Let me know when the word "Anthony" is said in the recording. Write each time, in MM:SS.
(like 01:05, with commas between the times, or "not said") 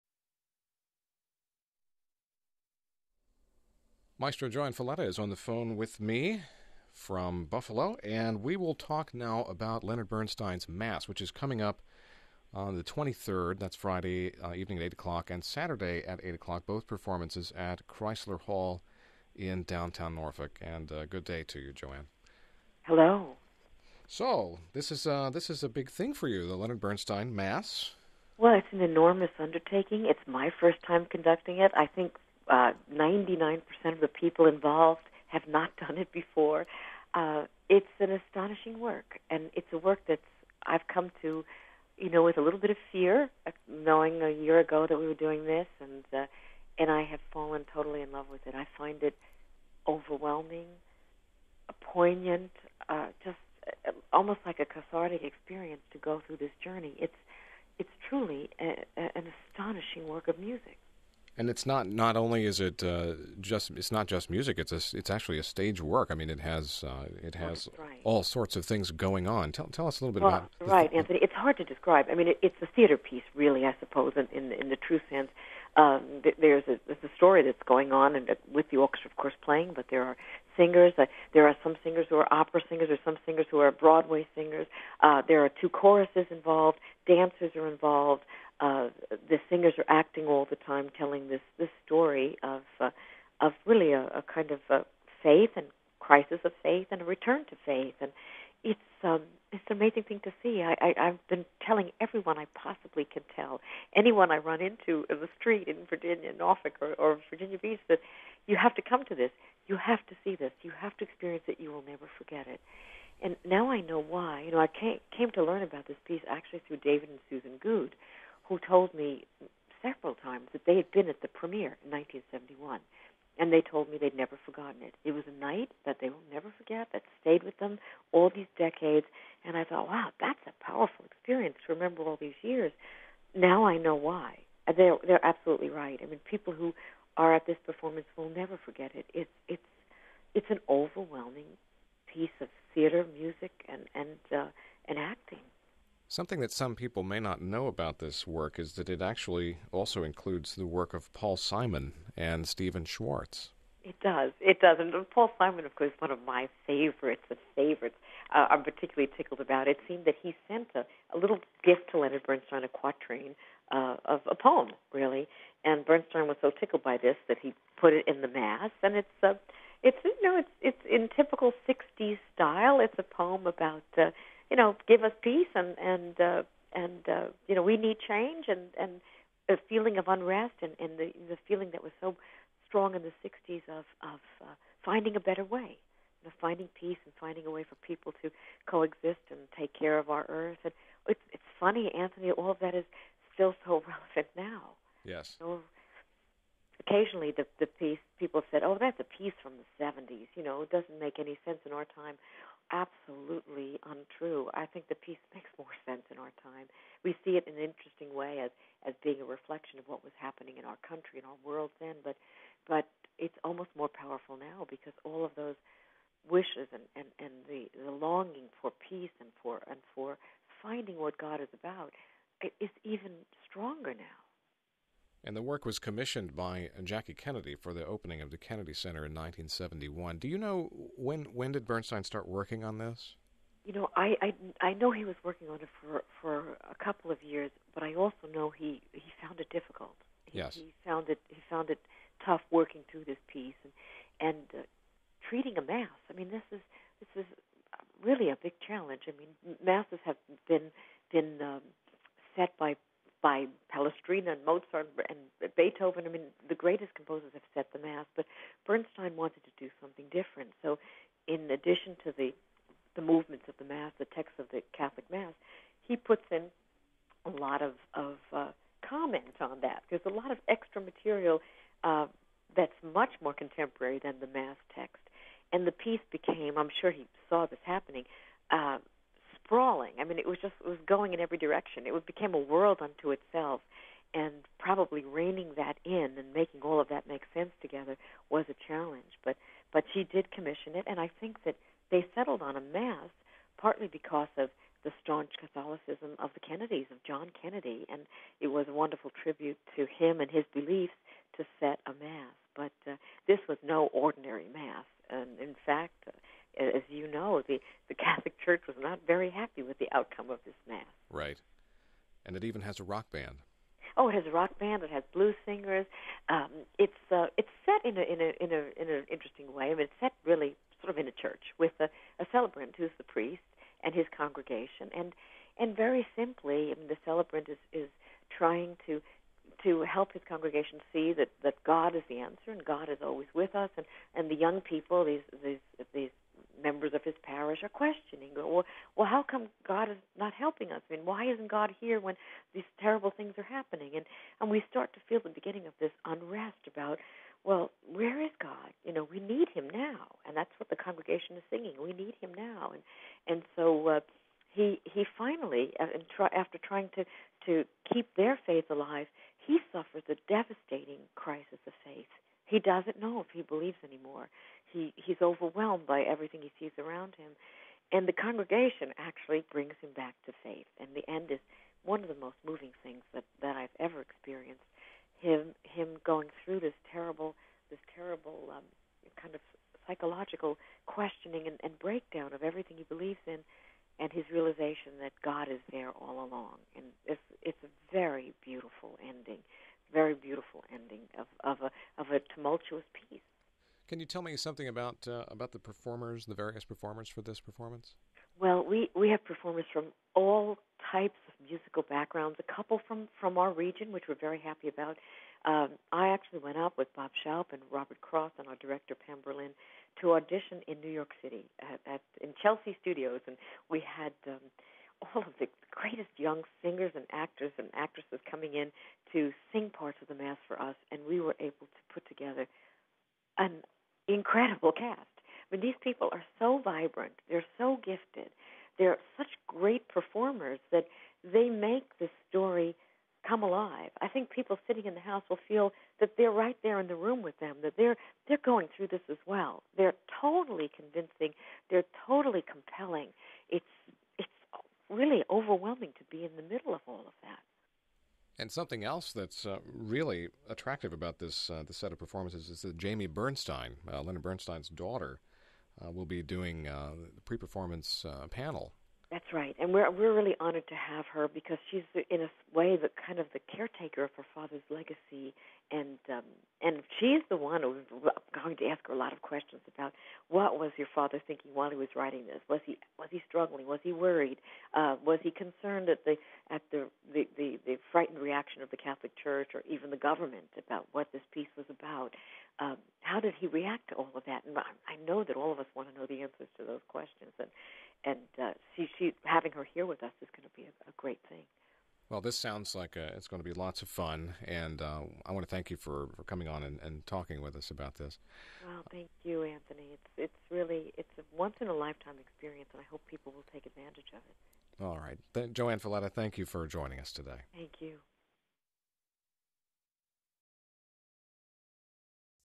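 01:10, 03:11, 08:19.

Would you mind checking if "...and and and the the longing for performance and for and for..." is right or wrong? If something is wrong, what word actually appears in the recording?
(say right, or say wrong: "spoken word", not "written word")
wrong: "peace", not "performance".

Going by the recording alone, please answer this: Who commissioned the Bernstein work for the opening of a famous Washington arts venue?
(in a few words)
Jackie Kennedy.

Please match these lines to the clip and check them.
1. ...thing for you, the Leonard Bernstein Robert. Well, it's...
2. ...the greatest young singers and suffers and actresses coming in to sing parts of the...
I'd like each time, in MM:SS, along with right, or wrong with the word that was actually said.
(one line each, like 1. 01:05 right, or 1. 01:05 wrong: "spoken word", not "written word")
1. 00:25 wrong: "Mass", not "Robert"
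2. 06:55 wrong: "actors", not "suffers".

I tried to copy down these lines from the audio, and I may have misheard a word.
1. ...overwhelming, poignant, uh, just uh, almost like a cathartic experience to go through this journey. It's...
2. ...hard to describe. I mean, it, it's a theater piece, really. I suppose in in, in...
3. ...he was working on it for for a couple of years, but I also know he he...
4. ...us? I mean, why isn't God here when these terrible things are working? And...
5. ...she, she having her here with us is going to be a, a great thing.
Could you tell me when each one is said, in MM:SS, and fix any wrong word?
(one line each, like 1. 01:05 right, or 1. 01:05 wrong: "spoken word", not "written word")
1. 00:49 right
2. 01:11 right
3. 03:54 right
4. 05:40 wrong: "happening", not "working"
5. 08:08 right.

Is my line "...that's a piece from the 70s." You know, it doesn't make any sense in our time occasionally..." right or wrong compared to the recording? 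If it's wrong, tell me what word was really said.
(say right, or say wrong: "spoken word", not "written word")
wrong: "absolutely", not "occasionally".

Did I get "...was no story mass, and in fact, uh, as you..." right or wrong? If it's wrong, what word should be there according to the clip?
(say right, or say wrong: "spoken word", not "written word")
wrong: "ordinary", not "story".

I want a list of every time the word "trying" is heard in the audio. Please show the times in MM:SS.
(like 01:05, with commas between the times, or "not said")
05:28, 05:56.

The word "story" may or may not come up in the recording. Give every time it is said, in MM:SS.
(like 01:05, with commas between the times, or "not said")
01:17, 01:31, 07:12.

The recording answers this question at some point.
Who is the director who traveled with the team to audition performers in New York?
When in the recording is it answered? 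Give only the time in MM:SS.
06:48.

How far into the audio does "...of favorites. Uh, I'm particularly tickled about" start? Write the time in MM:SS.
02:37.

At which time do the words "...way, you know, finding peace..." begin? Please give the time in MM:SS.
03:05.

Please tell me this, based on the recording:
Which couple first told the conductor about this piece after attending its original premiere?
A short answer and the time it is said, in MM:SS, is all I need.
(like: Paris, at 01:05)
David and Susan Goode, at 01:56.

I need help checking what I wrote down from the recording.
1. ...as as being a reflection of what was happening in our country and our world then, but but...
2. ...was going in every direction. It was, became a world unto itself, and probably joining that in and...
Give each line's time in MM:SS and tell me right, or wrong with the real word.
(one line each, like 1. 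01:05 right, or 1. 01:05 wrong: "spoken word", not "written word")
1. 03:28 right
2. 04:40 wrong: "reining", not "joining".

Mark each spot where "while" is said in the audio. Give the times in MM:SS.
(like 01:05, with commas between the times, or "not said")
07:51.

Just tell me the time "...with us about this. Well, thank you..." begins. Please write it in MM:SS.
08:17.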